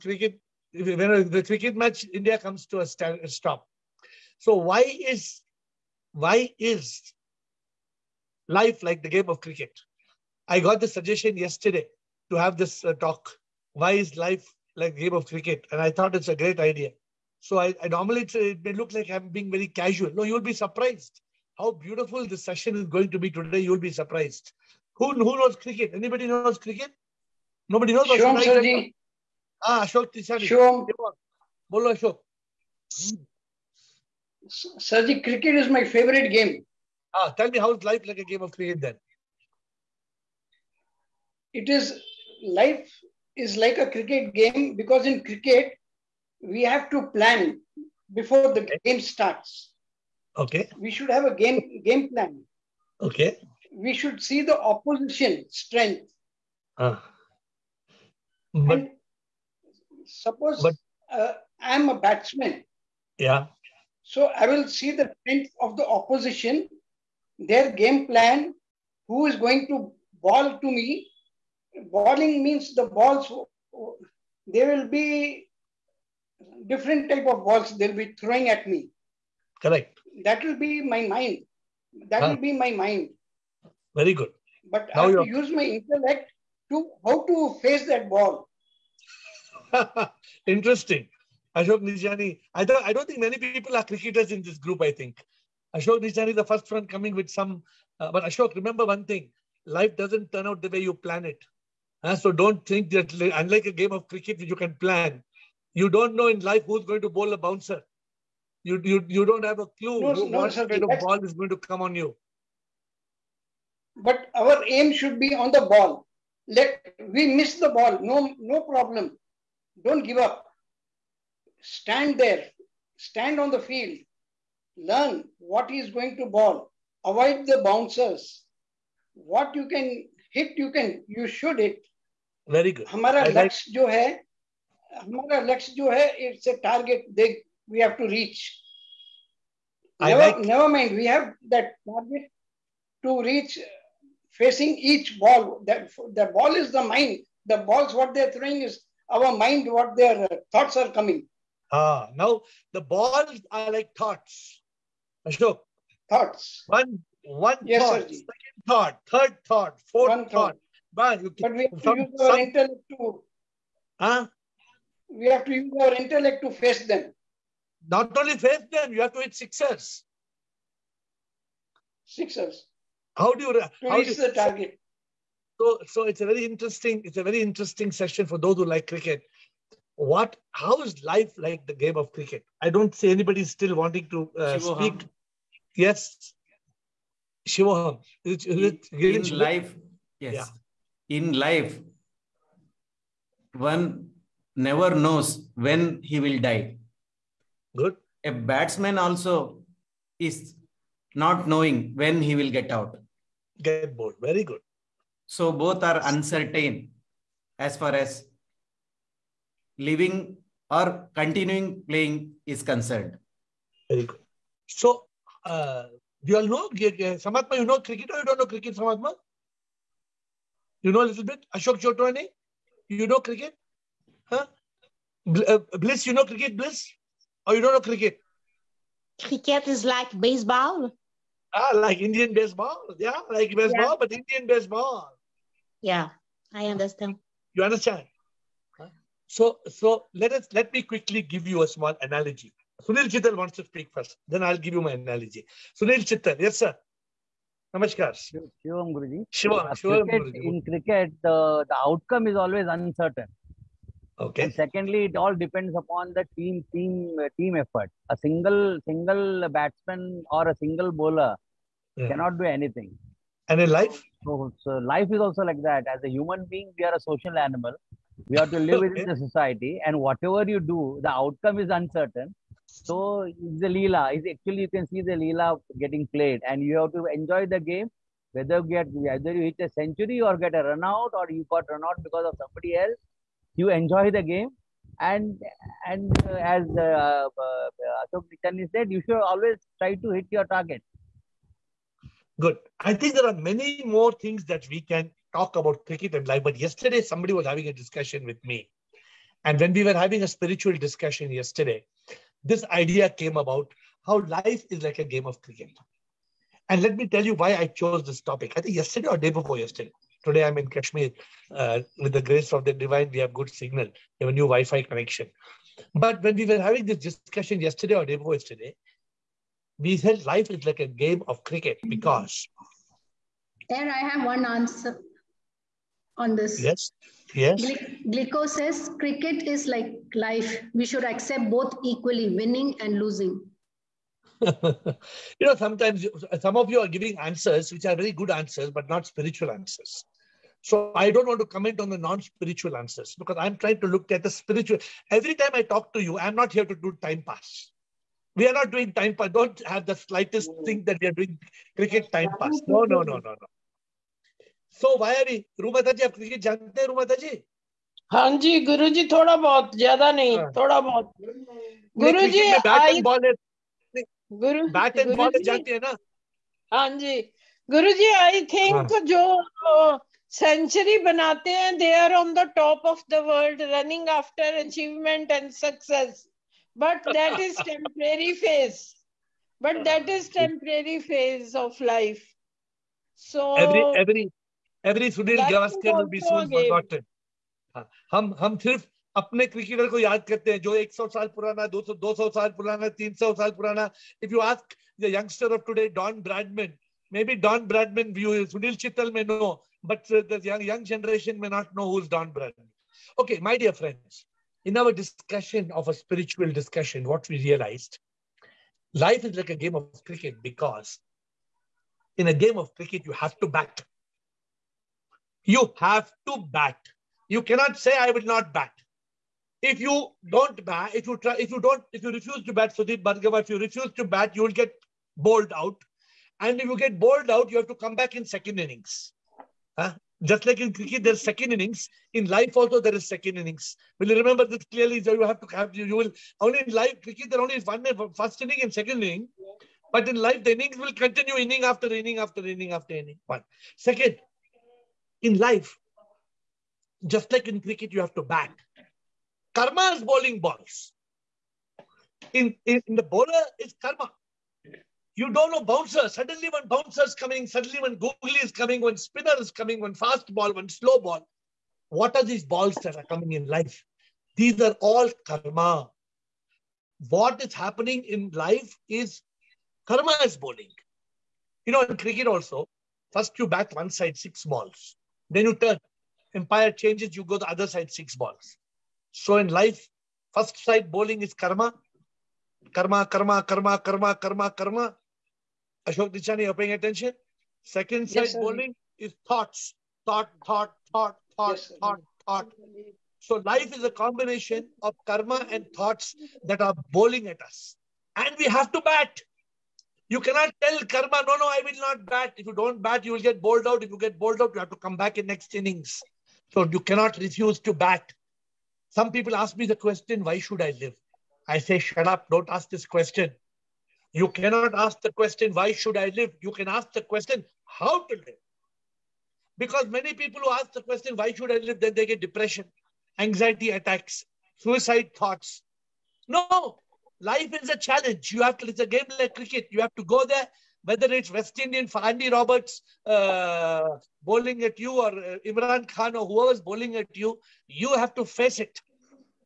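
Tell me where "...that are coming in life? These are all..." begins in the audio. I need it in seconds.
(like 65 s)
462 s.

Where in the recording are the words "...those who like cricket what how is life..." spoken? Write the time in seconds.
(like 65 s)
178 s.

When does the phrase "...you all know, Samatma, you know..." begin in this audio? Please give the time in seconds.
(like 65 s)
216 s.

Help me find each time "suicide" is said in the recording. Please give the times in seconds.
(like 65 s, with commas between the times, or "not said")
524 s.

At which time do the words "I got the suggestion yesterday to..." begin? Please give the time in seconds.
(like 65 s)
10 s.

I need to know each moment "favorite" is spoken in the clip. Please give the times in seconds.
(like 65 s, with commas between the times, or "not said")
35 s.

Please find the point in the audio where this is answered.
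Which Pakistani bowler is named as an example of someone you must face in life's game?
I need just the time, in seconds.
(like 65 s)
535 s.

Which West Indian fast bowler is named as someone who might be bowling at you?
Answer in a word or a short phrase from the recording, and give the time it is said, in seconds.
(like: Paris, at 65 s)
Andy Roberts, at 532 s.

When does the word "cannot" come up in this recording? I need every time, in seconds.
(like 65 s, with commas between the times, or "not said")
262 s, 417 s, 500 s, 506 s, 514 s.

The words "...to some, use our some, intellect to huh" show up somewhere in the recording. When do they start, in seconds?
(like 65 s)
161 s.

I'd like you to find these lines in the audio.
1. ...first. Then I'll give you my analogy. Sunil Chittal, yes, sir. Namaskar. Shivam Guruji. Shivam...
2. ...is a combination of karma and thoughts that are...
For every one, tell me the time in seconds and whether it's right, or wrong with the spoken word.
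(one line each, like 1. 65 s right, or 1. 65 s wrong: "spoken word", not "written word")
1. 243 s right
2. 493 s right.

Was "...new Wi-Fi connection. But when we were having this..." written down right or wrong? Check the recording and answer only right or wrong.
right.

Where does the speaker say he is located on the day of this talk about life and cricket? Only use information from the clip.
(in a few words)
Kashmir.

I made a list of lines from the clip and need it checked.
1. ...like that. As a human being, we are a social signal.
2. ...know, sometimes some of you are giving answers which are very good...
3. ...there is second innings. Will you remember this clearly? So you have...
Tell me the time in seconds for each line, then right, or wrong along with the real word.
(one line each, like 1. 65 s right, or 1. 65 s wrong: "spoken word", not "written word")
1. 265 s wrong: "animal", not "signal"
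2. 335 s right
3. 432 s right.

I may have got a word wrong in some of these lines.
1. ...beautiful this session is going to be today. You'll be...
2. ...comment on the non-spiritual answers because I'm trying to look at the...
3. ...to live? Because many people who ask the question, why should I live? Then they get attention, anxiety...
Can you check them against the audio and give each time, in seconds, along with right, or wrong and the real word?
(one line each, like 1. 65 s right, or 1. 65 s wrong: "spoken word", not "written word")
1. 21 s right
2. 341 s right
3. 518 s wrong: "depression", not "attention".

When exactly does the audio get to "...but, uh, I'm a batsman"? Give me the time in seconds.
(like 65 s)
60 s.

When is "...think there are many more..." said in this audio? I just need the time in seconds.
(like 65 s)
292 s.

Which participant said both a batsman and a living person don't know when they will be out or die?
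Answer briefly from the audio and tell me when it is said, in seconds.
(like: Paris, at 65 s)
Shivoham, at 187 s.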